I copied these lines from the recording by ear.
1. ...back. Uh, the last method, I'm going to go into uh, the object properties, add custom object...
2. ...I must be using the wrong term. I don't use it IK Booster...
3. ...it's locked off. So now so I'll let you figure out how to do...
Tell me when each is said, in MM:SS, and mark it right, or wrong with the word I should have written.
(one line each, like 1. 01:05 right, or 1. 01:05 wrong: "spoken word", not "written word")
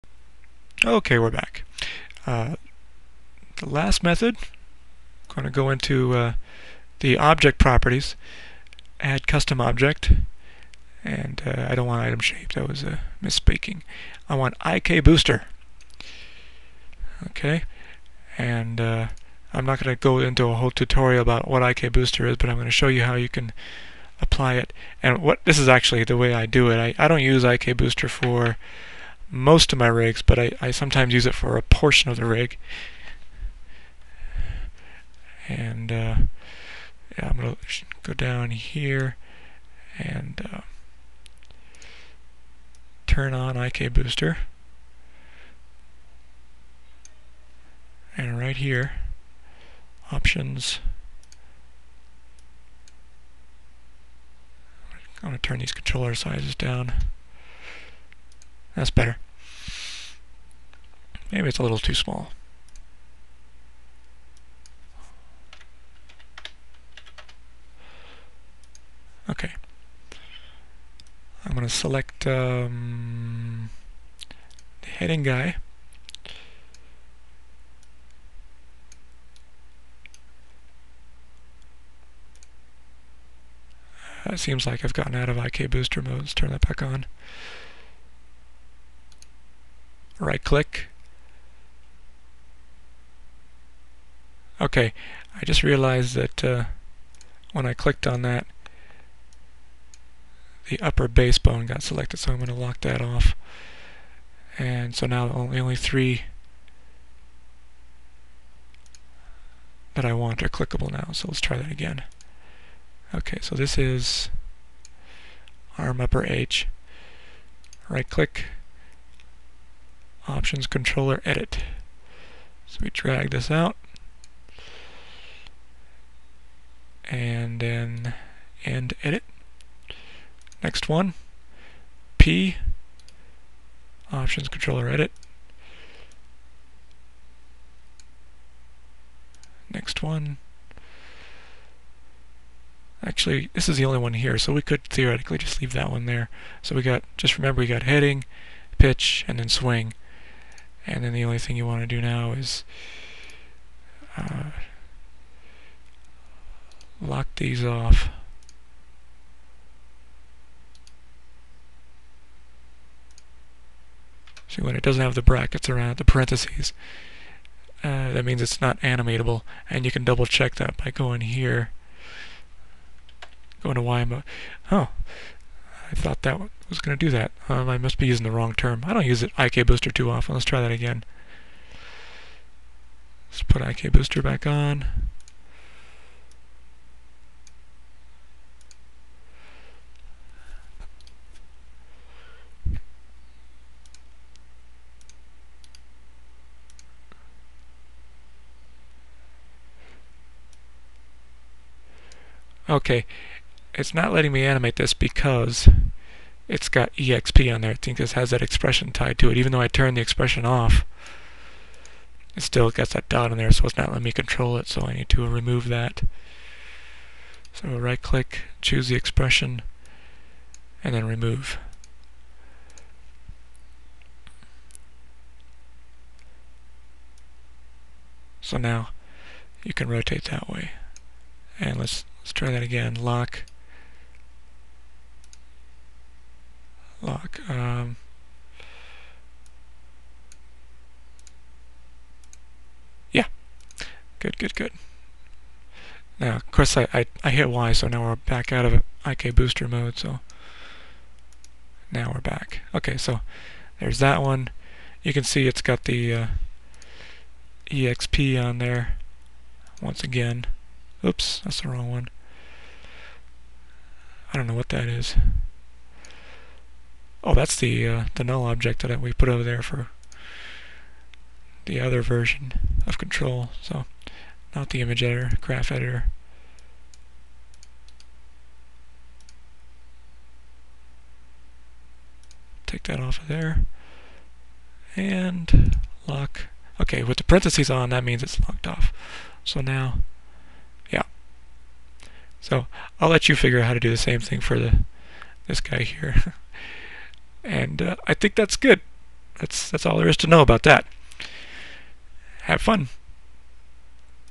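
1. 00:01 right
2. 02:57 right
3. 04:48 right.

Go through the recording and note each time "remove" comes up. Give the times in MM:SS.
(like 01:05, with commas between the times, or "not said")
03:35, 03:41.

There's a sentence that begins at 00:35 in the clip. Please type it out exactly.
And uh, yeah, I'm going to go down here and uh, turn on IK Booster.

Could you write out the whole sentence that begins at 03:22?
Okay, it's not letting me animate this because it's got EXP on there.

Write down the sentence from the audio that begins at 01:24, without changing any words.
It seems like I've gotten out of IK booster mode.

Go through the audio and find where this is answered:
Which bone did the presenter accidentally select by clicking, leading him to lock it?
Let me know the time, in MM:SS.
01:40.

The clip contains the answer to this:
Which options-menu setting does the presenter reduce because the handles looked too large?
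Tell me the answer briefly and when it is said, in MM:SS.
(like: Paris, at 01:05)
controller sizes, at 00:55.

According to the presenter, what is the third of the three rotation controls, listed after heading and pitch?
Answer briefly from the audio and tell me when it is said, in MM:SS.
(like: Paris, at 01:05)
swing, at 02:29.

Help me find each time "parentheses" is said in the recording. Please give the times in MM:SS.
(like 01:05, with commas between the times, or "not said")
02:46, 04:47.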